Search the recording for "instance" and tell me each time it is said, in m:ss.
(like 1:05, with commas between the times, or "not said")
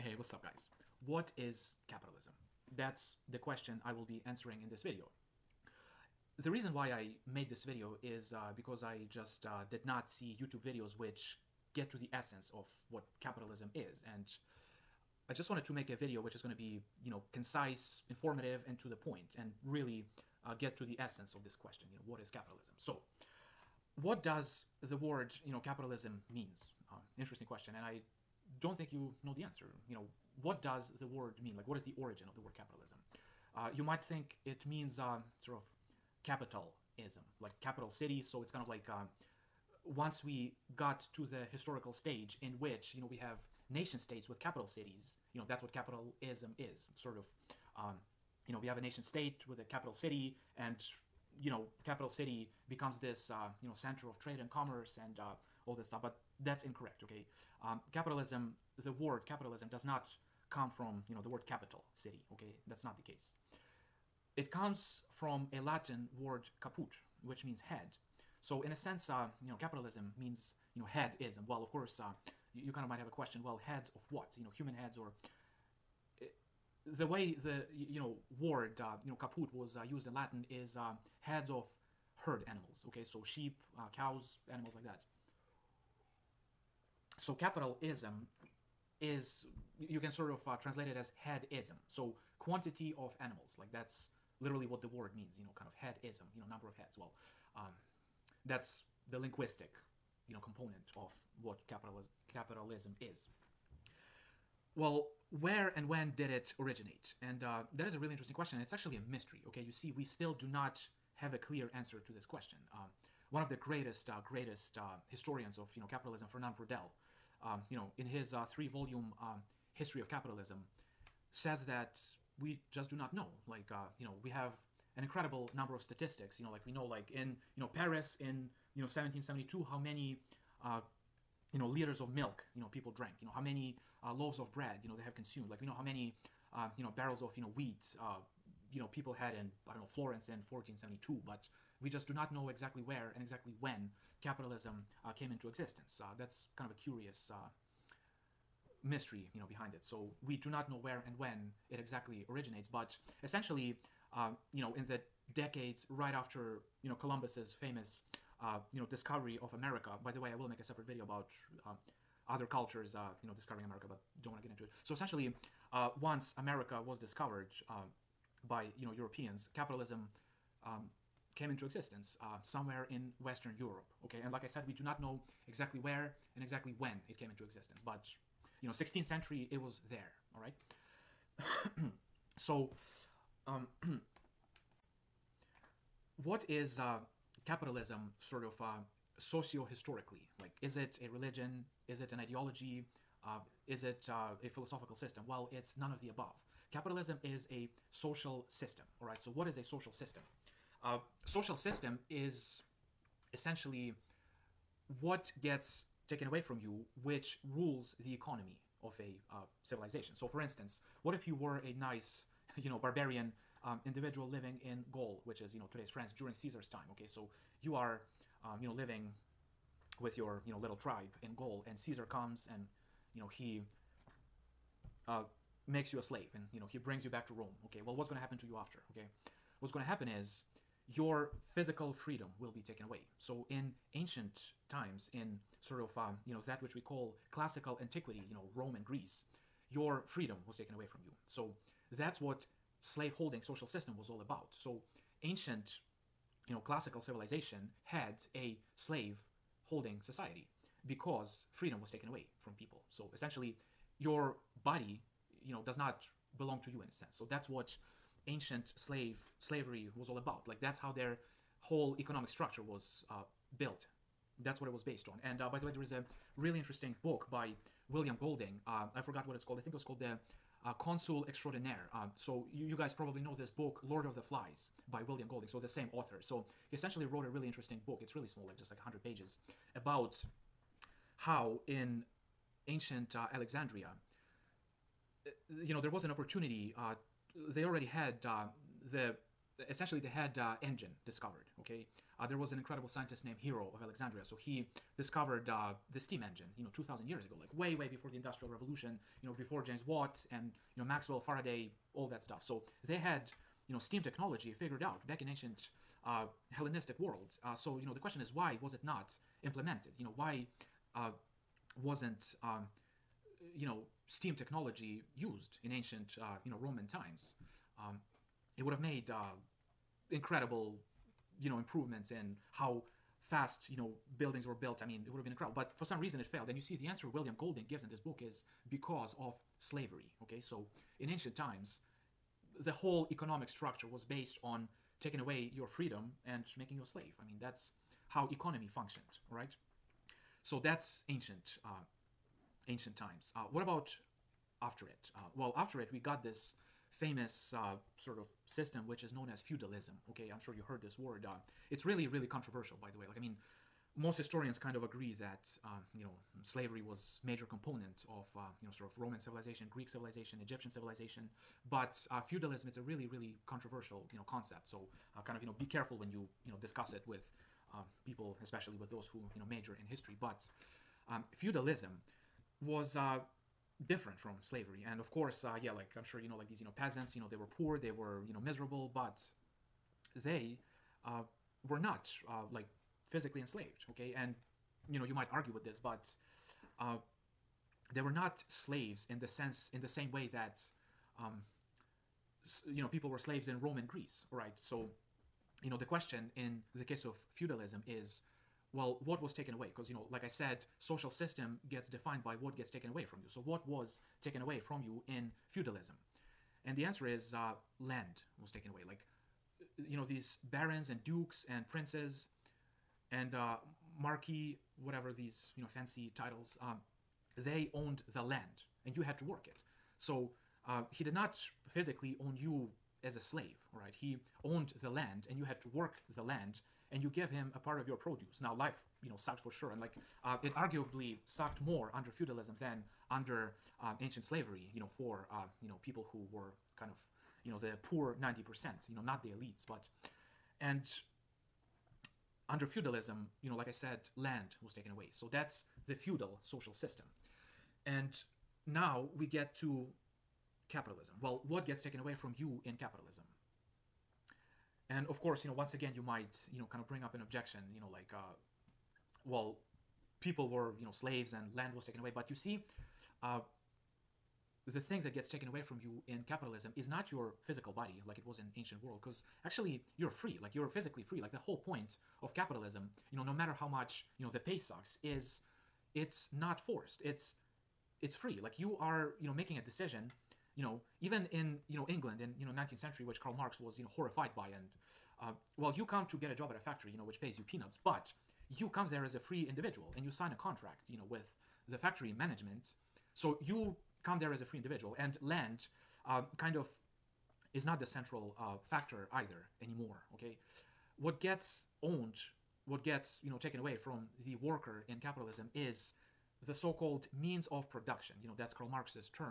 3:30.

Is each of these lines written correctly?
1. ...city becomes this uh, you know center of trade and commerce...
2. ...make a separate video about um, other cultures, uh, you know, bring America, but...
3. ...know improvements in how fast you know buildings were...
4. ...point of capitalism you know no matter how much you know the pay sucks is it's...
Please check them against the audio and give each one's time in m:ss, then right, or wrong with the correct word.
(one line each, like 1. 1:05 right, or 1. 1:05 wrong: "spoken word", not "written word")
1. 0:52 right
2. 2:40 wrong: "discovering", not "bring"
3. 5:21 right
4. 7:51 right.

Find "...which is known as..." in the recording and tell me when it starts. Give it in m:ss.
5:48.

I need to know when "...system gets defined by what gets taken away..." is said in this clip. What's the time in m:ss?
6:41.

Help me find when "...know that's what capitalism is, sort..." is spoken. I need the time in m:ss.
0:45.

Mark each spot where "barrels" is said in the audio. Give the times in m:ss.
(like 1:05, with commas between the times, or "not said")
2:16.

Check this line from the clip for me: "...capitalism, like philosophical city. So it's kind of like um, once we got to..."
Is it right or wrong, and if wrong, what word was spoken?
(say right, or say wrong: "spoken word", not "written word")
wrong: "capital", not "philosophical".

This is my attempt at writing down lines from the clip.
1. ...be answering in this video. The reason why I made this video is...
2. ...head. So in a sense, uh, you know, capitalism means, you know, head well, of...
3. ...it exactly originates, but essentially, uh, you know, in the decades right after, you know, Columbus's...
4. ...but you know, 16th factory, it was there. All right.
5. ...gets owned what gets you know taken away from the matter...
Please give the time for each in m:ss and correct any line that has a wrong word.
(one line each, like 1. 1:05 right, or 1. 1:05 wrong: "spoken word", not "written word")
1. 0:04 right
2. 1:07 right
3. 2:31 right
4. 2:57 wrong: "century", not "factory"
5. 8:21 wrong: "worker", not "matter".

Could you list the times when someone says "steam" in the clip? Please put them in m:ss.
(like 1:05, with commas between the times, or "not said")
4:55, 5:03, 5:14.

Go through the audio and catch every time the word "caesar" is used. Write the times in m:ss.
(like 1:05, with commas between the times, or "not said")
3:36, 3:41.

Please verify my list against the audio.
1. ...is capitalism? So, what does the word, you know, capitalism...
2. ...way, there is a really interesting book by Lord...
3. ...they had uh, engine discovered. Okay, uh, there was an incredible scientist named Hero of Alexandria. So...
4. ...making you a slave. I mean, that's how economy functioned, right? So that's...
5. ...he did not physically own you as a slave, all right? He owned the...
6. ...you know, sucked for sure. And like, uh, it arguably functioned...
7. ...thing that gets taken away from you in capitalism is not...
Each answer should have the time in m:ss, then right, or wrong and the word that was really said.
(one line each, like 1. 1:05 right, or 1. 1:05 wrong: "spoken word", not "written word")
1. 0:22 right
2. 4:25 wrong: "William", not "Lord"
3. 4:49 right
4. 5:36 right
5. 7:00 right
6. 7:09 wrong: "sucked", not "functioned"
7. 7:44 right.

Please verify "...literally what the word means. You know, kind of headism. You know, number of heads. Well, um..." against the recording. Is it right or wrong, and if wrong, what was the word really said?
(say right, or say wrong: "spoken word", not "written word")
right.